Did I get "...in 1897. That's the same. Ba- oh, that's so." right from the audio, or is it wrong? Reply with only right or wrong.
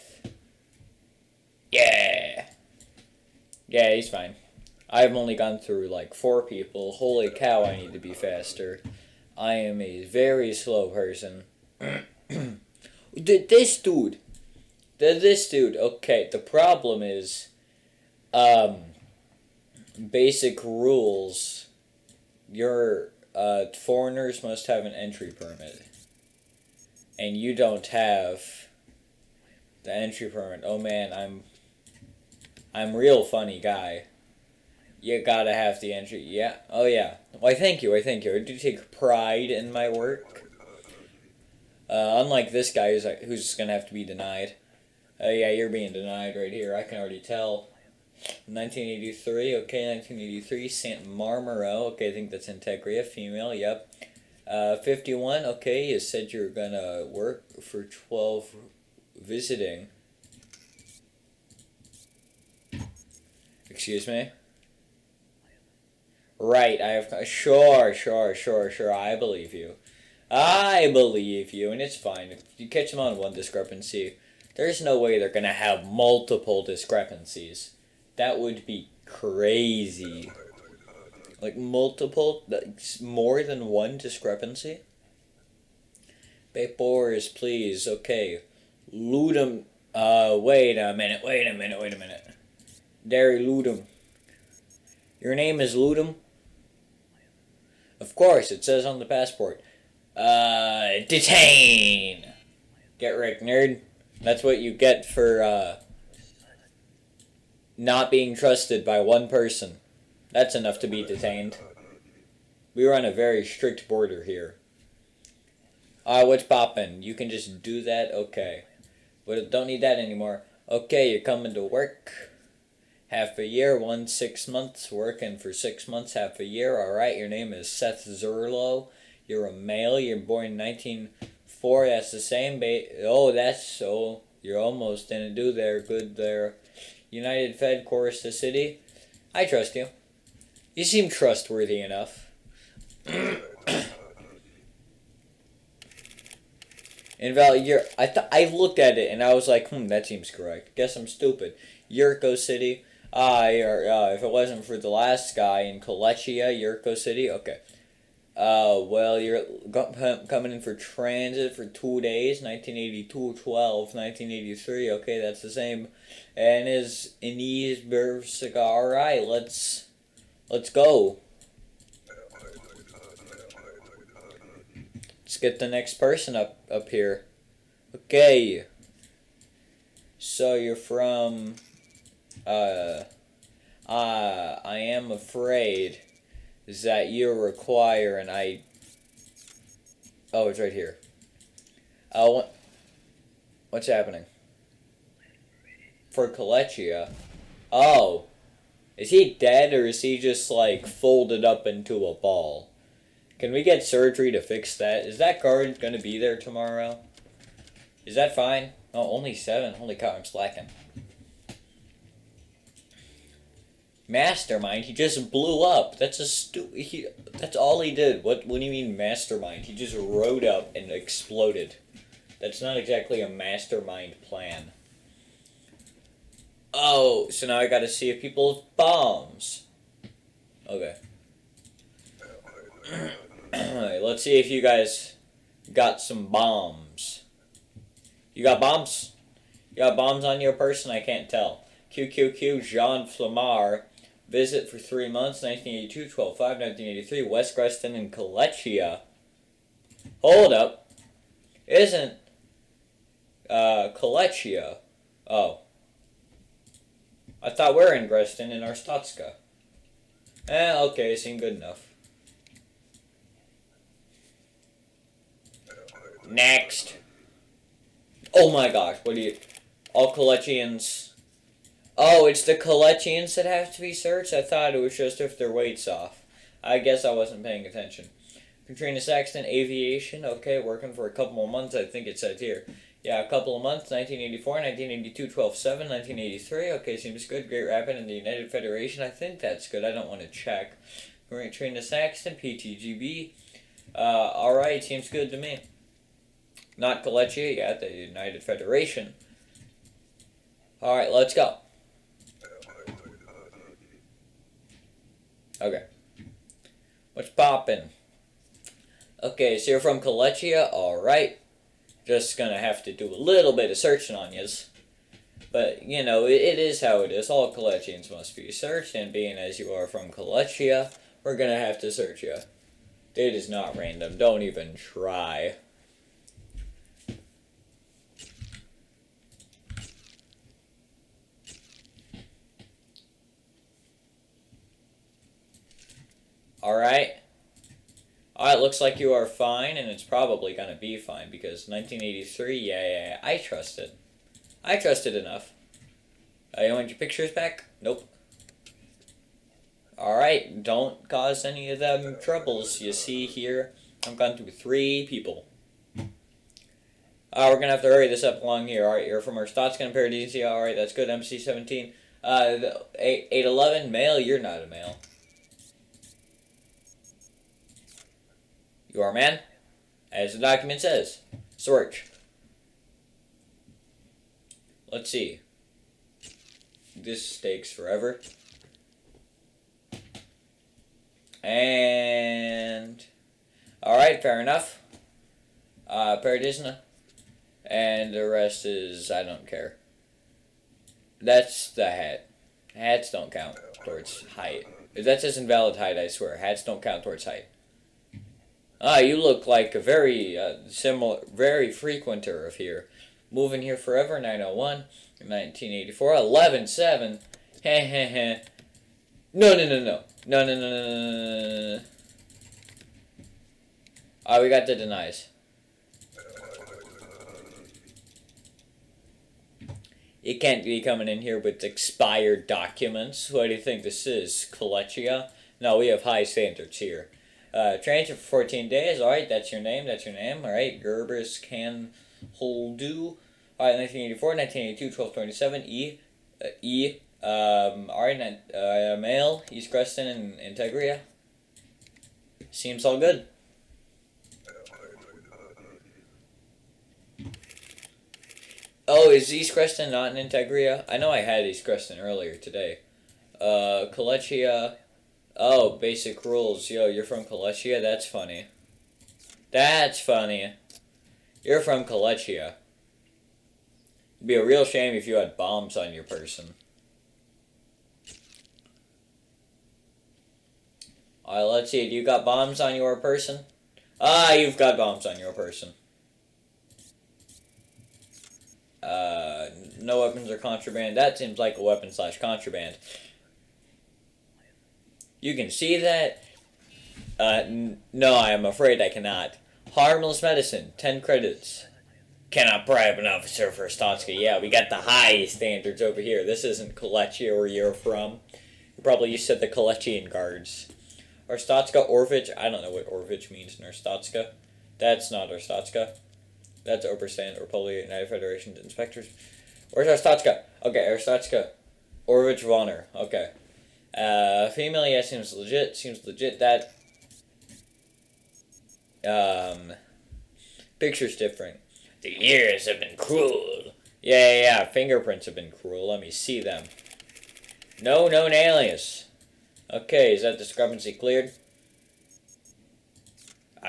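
wrong.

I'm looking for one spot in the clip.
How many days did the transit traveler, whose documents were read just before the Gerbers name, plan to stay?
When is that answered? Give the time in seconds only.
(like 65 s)
428 s.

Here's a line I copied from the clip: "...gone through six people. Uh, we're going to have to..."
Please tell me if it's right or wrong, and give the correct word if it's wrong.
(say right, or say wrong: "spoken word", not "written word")
wrong: "three", not "six".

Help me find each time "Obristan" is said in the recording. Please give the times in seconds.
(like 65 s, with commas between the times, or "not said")
506 s.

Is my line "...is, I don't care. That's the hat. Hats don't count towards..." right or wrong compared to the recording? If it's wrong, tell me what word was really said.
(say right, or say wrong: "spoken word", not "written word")
right.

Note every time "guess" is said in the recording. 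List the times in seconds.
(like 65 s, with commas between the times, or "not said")
150 s, 276 s.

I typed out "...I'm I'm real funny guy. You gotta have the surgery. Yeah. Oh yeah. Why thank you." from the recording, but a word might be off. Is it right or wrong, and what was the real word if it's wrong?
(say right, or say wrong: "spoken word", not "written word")
wrong: "entry", not "surgery".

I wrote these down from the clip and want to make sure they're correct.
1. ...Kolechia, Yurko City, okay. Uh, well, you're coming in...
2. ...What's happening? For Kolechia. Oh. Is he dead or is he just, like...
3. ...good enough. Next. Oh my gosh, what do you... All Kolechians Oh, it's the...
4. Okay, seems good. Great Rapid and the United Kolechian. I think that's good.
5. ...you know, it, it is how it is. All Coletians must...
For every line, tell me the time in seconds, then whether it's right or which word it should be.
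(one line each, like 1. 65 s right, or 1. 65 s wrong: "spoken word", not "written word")
1. 155 s right
2. 193 s right
3. 261 s right
4. 286 s wrong: "Federation", not "Kolechian"
5. 315 s right.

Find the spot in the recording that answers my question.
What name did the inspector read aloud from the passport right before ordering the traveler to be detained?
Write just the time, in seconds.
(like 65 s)
93 s.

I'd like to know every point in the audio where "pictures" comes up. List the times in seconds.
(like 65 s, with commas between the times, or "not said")
346 s, 520 s.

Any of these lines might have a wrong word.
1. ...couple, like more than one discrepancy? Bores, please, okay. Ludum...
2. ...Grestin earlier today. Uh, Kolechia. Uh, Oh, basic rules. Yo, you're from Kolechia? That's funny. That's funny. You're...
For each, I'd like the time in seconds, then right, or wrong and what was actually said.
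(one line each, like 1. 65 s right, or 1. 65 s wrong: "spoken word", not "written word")
1. 81 s wrong: "multiple", not "couple"
2. 451 s right.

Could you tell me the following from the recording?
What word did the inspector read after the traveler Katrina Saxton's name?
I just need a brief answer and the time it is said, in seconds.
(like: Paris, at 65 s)
aviation, at 279 s.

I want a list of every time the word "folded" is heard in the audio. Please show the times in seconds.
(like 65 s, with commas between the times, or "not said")
200 s.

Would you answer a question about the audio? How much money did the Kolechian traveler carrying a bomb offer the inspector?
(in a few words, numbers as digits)
10 credits.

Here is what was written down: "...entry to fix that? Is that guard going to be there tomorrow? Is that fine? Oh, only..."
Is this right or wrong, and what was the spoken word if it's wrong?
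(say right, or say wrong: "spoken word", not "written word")
wrong: "surgery", not "entry".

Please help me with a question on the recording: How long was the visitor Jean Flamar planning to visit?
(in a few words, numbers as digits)
three months.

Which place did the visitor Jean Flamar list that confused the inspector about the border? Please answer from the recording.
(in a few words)
West Grestin.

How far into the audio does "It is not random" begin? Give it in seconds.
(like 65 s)
323 s.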